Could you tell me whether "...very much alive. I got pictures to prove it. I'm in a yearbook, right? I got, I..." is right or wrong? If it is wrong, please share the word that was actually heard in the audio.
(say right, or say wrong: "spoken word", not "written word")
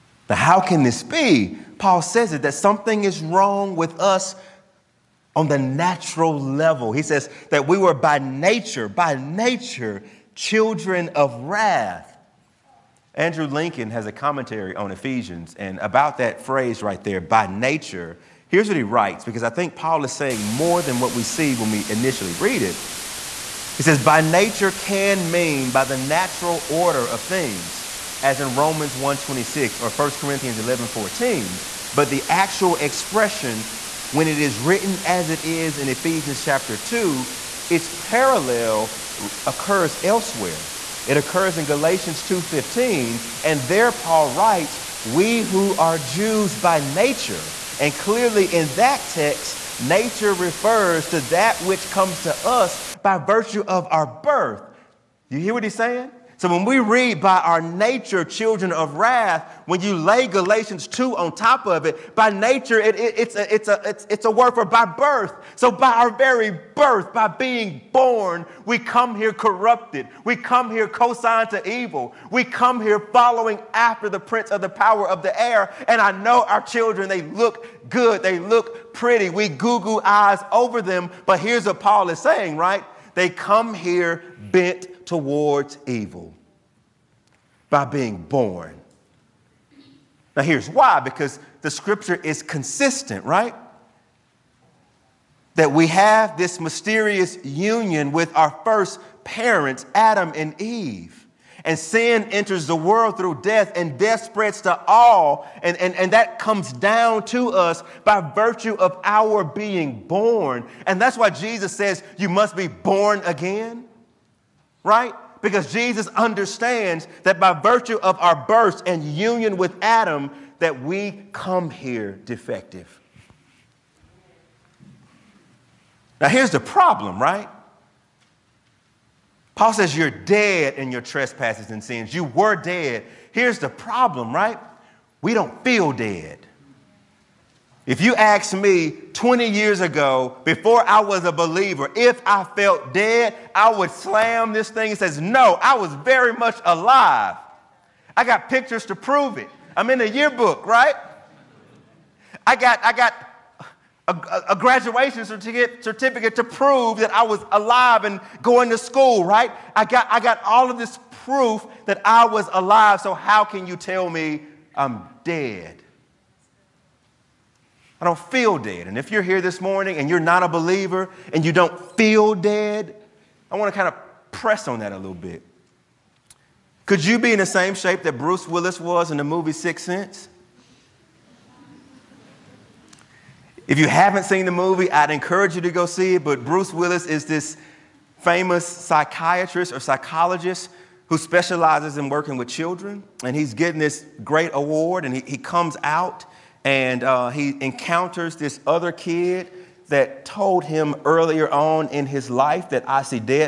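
right.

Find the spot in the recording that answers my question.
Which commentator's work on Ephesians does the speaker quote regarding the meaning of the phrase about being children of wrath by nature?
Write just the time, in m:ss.
0:13.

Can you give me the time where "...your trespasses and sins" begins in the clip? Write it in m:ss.
2:10.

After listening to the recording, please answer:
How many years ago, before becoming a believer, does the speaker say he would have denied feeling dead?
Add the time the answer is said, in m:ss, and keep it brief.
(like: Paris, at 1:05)
20, at 2:19.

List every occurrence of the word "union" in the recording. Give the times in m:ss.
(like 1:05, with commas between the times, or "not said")
1:37, 1:59.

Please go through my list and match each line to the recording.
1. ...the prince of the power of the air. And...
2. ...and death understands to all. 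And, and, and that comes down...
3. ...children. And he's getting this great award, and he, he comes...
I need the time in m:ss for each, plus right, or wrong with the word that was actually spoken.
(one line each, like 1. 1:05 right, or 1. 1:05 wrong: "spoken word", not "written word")
1. 1:14 right
2. 1:43 wrong: "spreads", not "understands"
3. 3:12 right.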